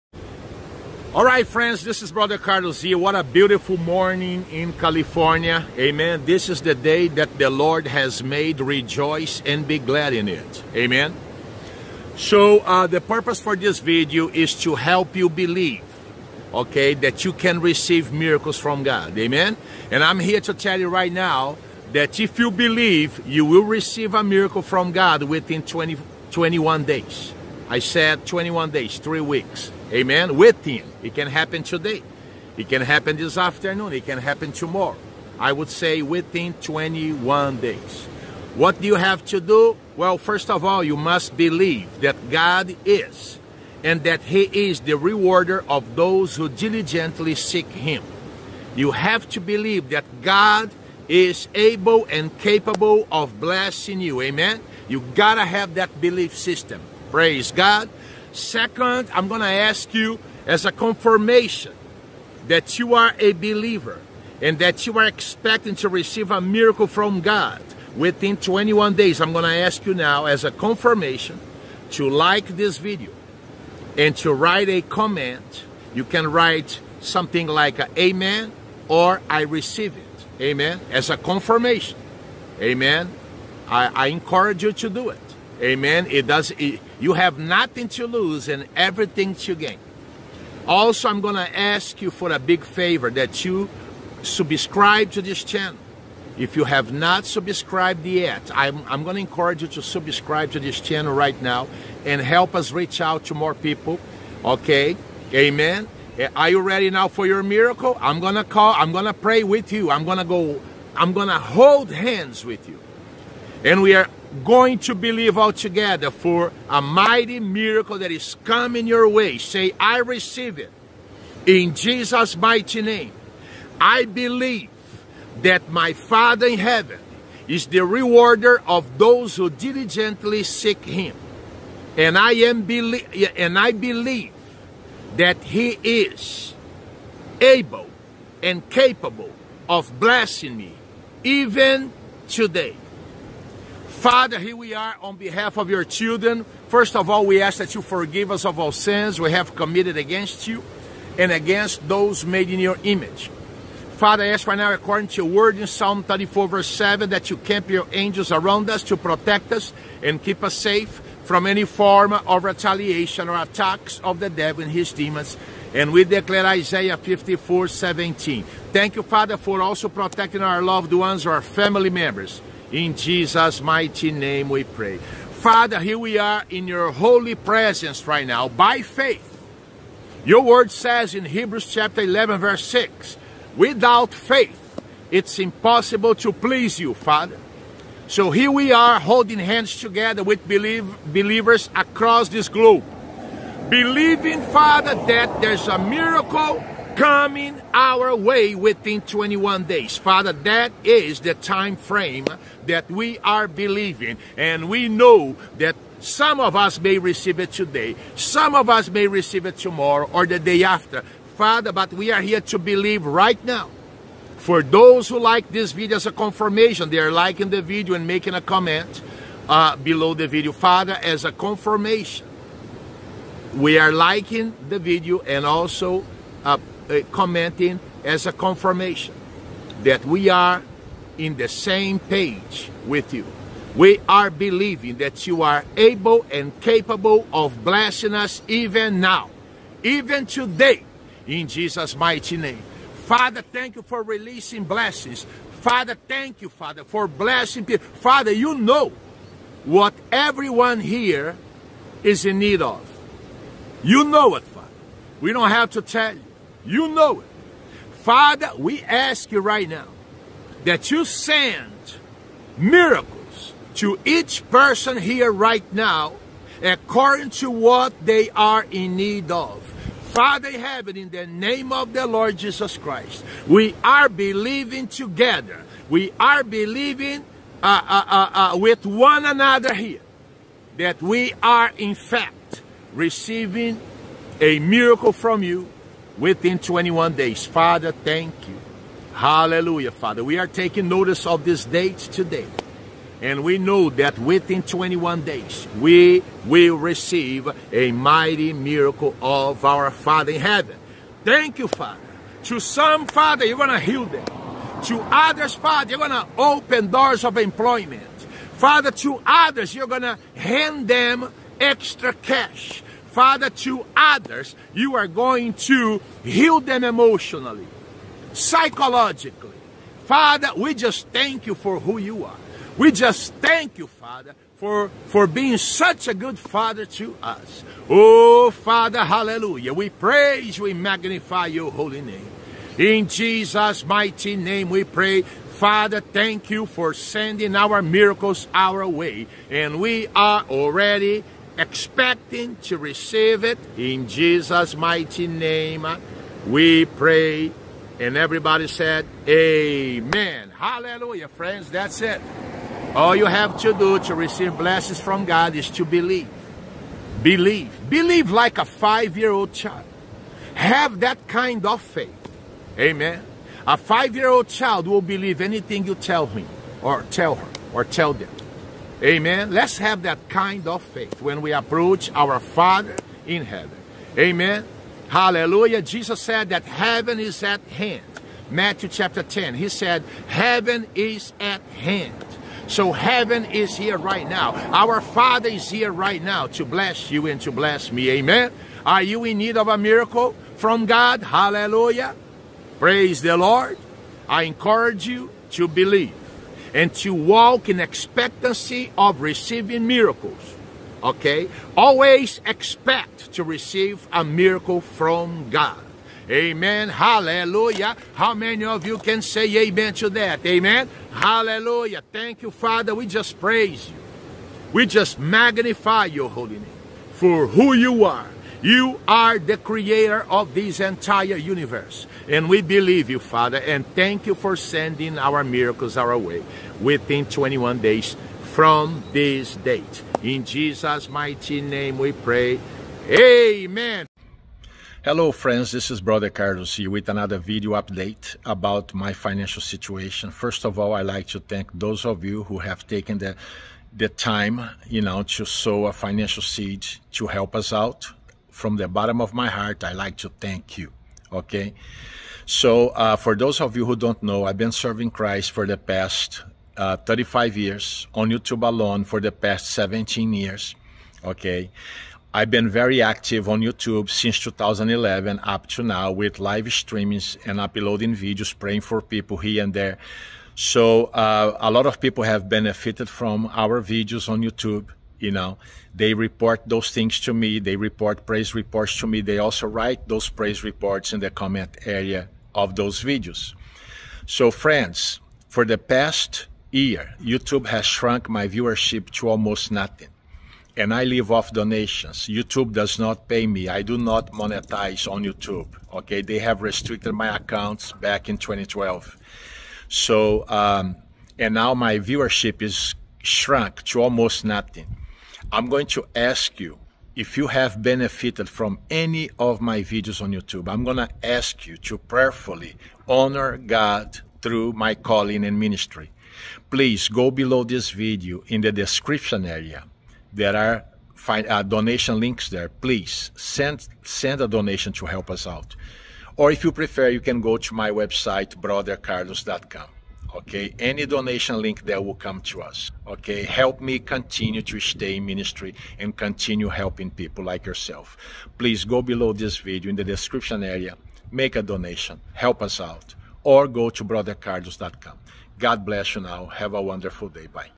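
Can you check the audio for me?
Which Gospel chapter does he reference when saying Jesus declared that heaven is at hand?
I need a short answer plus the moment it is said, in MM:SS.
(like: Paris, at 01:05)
Matthew 10, at 06:18.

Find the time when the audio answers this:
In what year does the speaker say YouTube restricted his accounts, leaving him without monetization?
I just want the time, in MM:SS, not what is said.
08:18.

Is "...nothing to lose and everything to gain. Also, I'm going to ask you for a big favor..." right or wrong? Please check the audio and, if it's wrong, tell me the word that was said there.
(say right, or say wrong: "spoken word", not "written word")
right.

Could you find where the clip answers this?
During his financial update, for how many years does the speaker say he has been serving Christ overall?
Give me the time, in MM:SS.
07:36.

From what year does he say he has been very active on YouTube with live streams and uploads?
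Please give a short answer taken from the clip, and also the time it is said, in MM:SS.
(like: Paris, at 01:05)
2011, at 07:44.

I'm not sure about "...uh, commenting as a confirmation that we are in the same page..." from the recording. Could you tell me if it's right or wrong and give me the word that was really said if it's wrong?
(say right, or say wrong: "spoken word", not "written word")
right.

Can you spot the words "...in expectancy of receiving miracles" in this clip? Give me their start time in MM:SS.
06:37.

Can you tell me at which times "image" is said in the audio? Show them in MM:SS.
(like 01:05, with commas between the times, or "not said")
02:32.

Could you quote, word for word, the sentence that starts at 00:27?
I said 21 days, three weeks.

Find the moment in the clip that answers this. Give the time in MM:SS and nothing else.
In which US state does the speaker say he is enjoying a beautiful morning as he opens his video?
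00:04.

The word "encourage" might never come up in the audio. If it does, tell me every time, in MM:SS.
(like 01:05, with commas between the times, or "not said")
01:24, 01:39, 06:34.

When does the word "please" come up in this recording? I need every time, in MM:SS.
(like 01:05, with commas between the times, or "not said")
03:06, 08:36, 08:42, 08:58.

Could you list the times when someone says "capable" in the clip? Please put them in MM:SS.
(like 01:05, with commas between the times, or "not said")
00:52, 02:18, 03:56.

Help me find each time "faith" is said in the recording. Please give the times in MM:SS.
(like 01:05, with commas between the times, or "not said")
02:58, 03:04, 06:01, 06:10.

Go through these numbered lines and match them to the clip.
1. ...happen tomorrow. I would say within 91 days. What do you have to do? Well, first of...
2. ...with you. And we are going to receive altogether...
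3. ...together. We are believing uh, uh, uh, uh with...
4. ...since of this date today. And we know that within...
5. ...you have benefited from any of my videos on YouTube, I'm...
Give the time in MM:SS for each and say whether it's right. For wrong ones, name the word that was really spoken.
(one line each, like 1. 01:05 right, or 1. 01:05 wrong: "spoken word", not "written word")
1. 00:34 wrong: "21", not "91"
2. 01:52 wrong: "believe", not "receive"
3. 04:34 right
4. 04:50 wrong: "notice", not "since"
5. 08:27 right.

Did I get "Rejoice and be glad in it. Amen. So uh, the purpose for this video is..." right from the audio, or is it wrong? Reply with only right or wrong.
right.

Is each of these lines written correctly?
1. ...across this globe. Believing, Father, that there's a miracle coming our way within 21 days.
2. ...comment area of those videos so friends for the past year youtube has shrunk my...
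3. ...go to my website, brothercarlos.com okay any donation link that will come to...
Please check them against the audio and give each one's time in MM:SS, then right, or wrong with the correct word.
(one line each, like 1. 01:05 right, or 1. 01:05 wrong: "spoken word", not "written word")
1. 03:11 right
2. 08:01 right
3. 08:47 right.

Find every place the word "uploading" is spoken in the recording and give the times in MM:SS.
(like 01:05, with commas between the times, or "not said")
07:47.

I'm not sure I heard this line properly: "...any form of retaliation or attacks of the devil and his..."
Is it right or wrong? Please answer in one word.
right.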